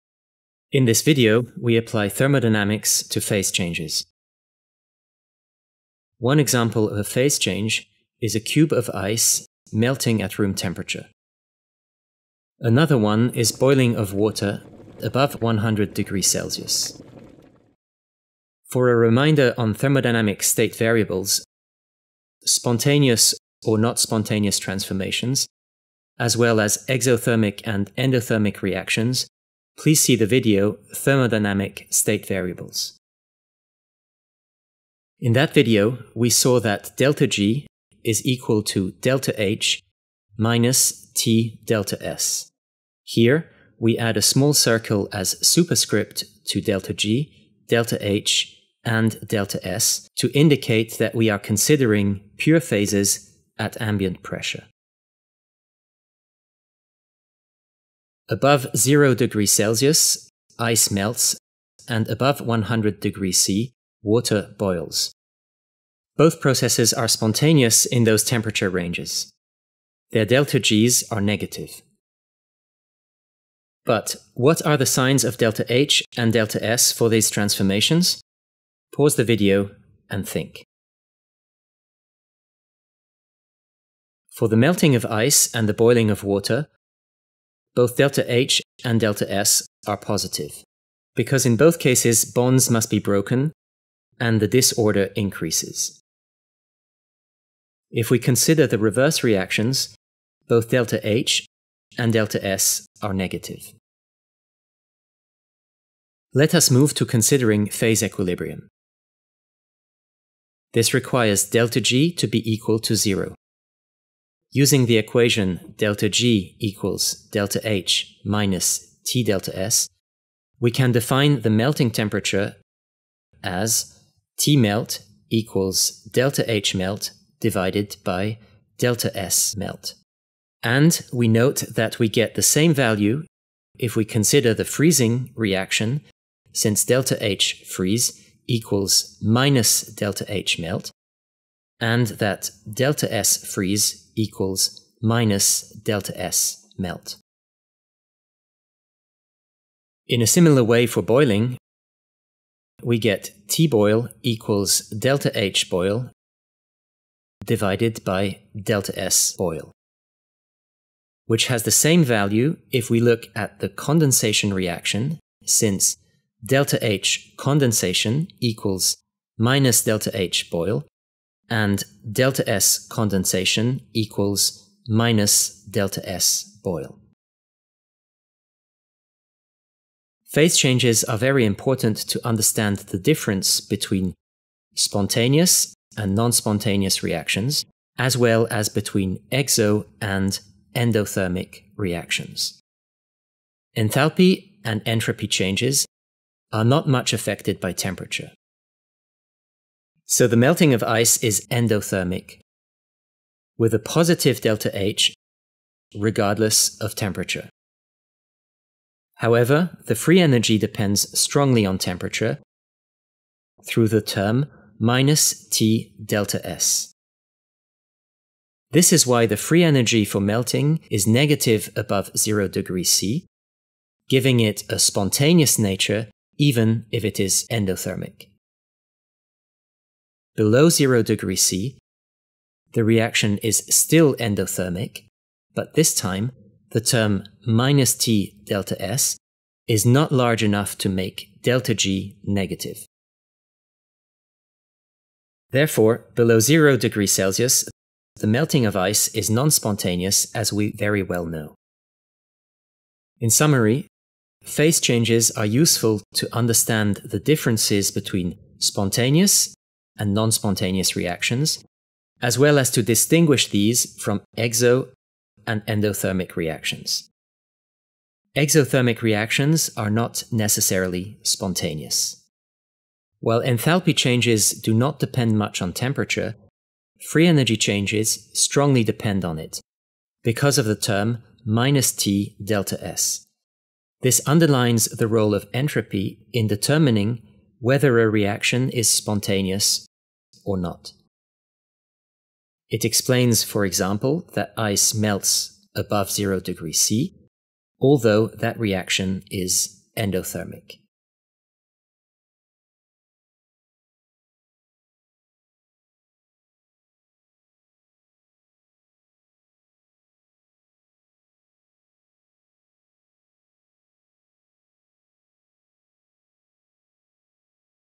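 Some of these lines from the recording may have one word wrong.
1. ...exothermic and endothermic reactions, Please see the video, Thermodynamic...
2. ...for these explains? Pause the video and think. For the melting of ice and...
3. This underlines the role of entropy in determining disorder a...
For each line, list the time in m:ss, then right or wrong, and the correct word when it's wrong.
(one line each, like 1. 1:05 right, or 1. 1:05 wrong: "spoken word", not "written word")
1. 0:26 right
2. 1:16 wrong: "transformations", not "explains"
3. 4:44 wrong: "whether", not "disorder".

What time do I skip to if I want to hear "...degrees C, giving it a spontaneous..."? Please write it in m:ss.
3:42.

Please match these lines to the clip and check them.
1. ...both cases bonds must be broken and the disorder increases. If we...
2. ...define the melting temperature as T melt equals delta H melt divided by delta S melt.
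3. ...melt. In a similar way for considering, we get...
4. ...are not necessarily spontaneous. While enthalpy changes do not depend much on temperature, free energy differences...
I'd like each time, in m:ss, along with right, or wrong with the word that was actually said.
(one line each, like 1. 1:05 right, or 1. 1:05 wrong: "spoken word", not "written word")
1. 1:31 right
2. 2:00 right
3. 2:26 wrong: "boiling", not "considering"
4. 4:29 wrong: "changes", not "differences".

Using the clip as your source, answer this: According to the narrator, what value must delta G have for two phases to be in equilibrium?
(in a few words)
equal to zero.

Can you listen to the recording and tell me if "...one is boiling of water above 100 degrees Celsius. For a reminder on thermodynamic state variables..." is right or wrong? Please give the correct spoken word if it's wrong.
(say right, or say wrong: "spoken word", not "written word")
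right.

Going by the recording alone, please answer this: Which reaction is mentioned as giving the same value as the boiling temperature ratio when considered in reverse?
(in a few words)
condensation reaction.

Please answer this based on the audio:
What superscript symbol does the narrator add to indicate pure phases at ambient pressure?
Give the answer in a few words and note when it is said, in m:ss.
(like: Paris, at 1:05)
small circle, at 0:44.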